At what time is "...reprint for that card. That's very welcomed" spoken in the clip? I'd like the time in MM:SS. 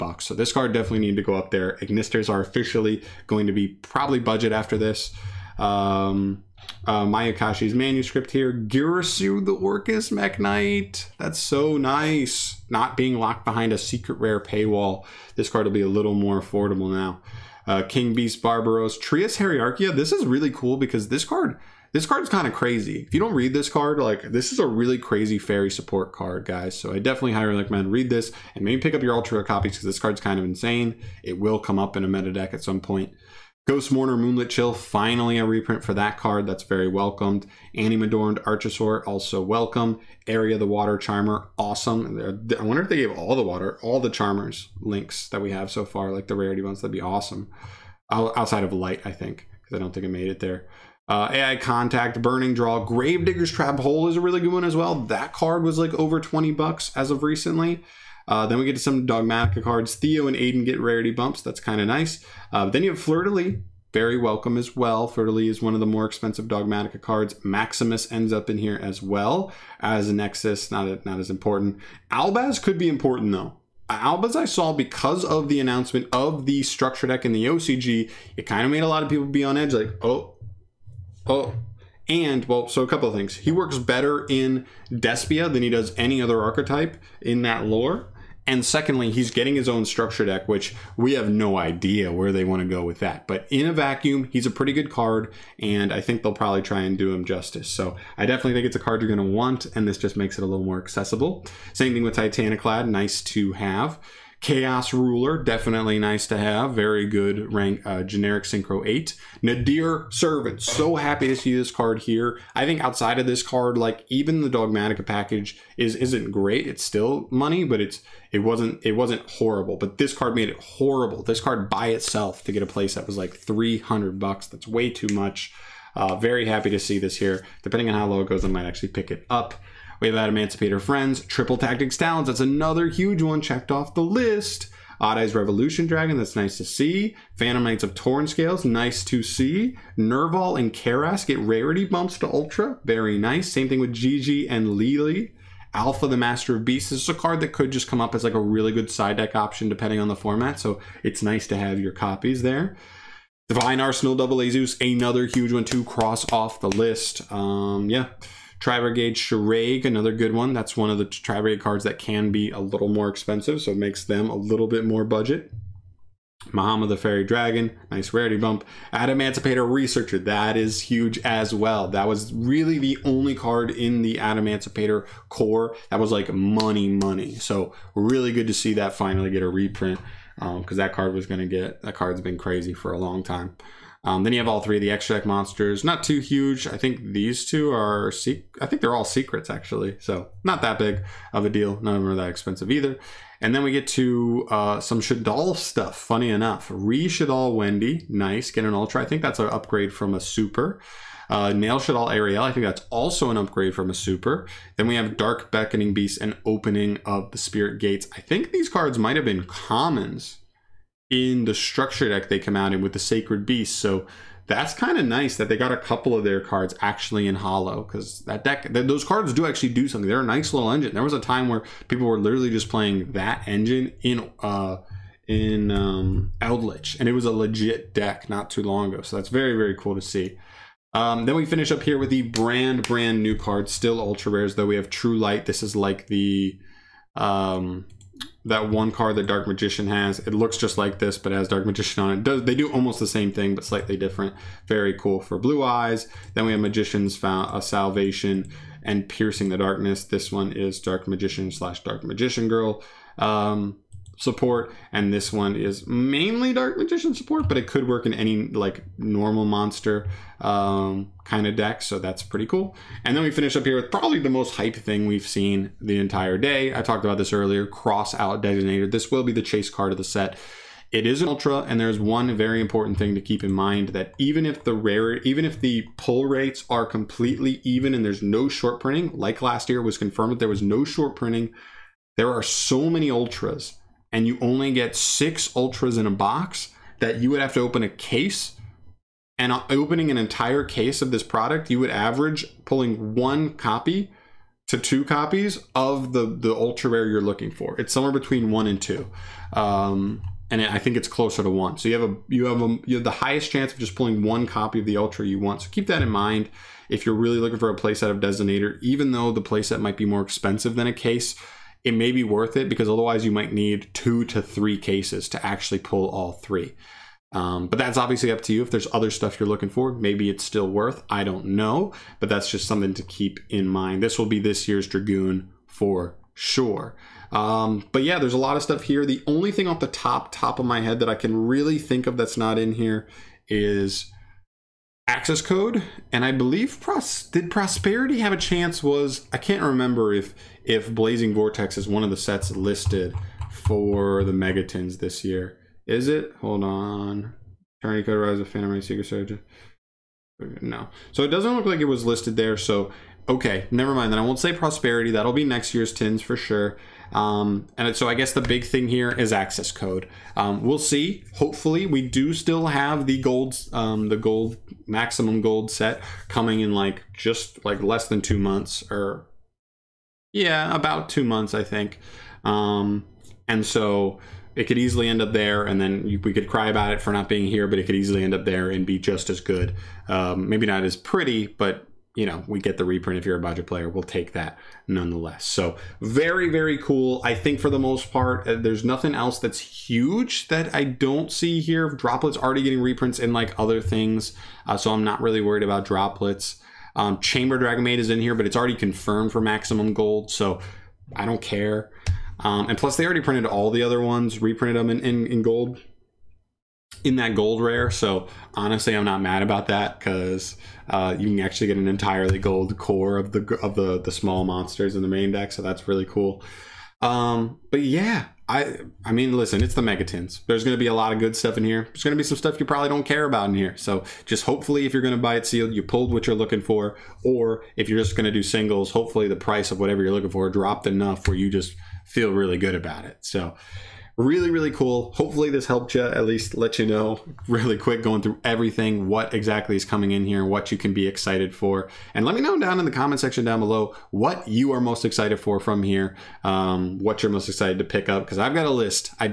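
00:35.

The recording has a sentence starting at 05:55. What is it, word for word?
That'll be next year's tins for sure.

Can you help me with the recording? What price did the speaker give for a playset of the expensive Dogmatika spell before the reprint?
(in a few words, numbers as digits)
$300.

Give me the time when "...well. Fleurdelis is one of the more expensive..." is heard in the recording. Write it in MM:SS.
01:04.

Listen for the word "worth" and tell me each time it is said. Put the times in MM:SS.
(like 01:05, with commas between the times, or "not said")
05:12, 05:20.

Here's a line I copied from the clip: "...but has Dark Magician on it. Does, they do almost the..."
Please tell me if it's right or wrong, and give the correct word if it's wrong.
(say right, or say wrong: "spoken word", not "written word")
right.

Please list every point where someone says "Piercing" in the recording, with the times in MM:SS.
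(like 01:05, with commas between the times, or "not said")
04:09.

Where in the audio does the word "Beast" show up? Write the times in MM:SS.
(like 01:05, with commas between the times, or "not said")
00:18, 02:26, 03:25, 03:33.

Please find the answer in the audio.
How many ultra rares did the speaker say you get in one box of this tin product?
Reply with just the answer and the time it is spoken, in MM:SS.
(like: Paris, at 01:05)
6, at 04:44.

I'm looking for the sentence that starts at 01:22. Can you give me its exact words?
And, well, so a couple of things.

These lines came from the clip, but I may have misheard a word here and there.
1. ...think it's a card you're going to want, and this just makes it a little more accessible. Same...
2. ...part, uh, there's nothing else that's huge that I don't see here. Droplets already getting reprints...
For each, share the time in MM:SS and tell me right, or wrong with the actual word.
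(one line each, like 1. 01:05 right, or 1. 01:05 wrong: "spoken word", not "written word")
1. 01:38 right
2. 06:28 right.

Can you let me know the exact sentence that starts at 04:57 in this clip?
It's somewhere between one and two, um, and I think it's closer to one.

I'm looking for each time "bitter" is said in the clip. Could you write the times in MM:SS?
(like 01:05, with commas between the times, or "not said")
not said.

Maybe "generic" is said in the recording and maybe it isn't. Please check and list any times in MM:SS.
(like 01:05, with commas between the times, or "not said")
01:48.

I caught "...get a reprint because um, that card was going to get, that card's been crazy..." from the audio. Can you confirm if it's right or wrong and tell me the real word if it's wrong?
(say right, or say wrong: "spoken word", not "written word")
right.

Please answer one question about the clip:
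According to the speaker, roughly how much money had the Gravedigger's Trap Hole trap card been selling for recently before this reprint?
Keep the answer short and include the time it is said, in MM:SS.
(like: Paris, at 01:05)
over $20, at 00:55.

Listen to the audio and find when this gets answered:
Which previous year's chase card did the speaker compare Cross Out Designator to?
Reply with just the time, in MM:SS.
05:24.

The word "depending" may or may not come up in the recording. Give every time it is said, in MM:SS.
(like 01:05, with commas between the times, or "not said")
02:07, 02:29.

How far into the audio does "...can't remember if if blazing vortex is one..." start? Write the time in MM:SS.
05:39.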